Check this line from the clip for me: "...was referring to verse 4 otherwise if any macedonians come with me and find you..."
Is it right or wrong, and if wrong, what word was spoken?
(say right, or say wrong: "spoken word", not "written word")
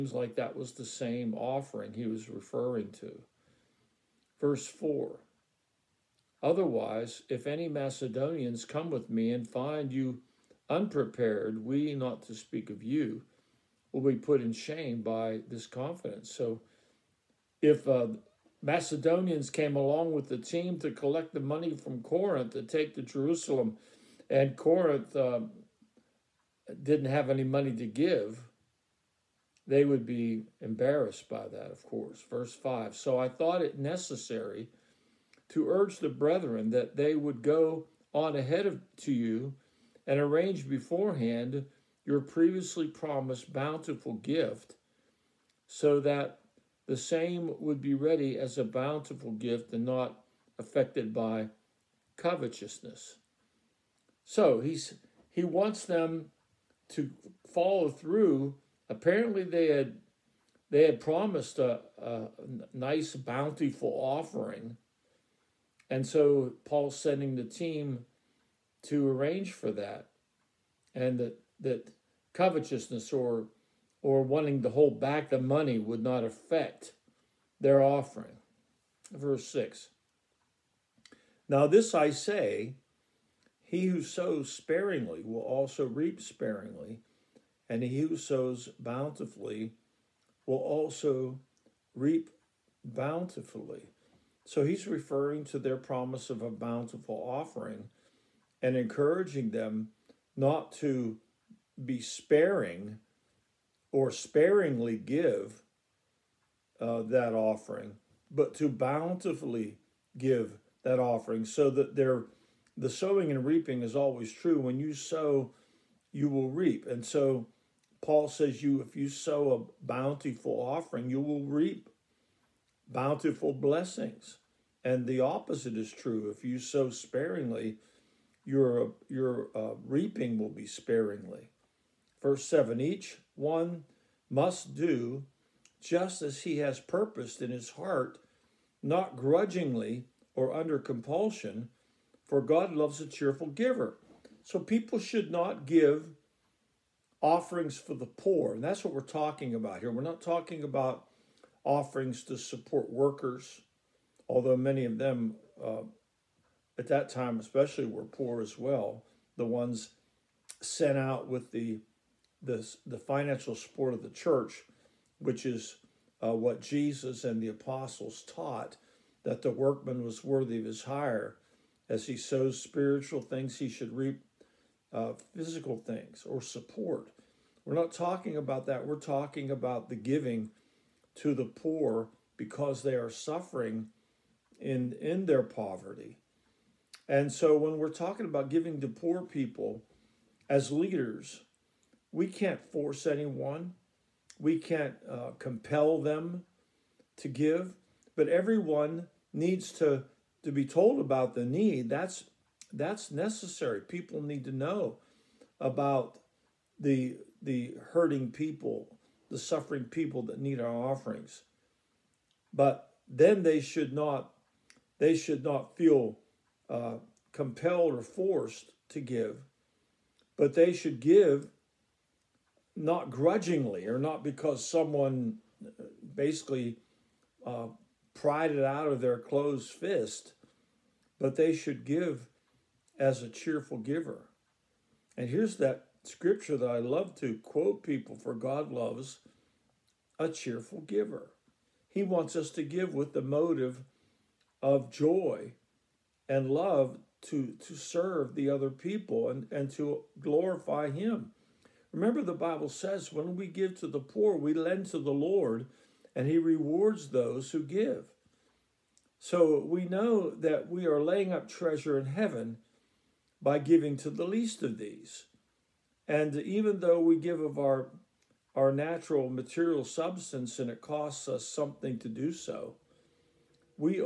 right.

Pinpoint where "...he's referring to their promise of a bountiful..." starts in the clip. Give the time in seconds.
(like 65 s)
94 s.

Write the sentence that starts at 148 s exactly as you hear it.
And that's what we're talking about here.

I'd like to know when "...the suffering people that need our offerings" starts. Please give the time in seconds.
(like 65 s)
209 s.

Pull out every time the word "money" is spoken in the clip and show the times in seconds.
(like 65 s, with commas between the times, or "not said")
21 s, 27 s, 75 s.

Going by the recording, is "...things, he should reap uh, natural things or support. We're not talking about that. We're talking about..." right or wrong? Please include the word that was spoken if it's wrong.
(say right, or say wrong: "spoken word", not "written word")
wrong: "physical", not "natural".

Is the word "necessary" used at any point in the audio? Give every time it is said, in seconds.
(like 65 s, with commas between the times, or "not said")
33 s, 203 s.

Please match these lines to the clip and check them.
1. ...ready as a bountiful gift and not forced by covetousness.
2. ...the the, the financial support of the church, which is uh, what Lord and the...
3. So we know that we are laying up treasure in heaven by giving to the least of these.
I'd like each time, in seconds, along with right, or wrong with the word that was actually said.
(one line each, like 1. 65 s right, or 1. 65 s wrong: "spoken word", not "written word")
1. 47 s wrong: "affected", not "forced"
2. 161 s wrong: "Jesus", not "Lord"
3. 259 s right.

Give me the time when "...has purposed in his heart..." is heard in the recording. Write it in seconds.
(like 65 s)
136 s.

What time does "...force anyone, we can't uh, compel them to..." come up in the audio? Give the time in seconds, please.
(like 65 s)
192 s.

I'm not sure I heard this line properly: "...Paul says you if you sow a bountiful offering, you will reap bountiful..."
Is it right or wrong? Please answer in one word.
right.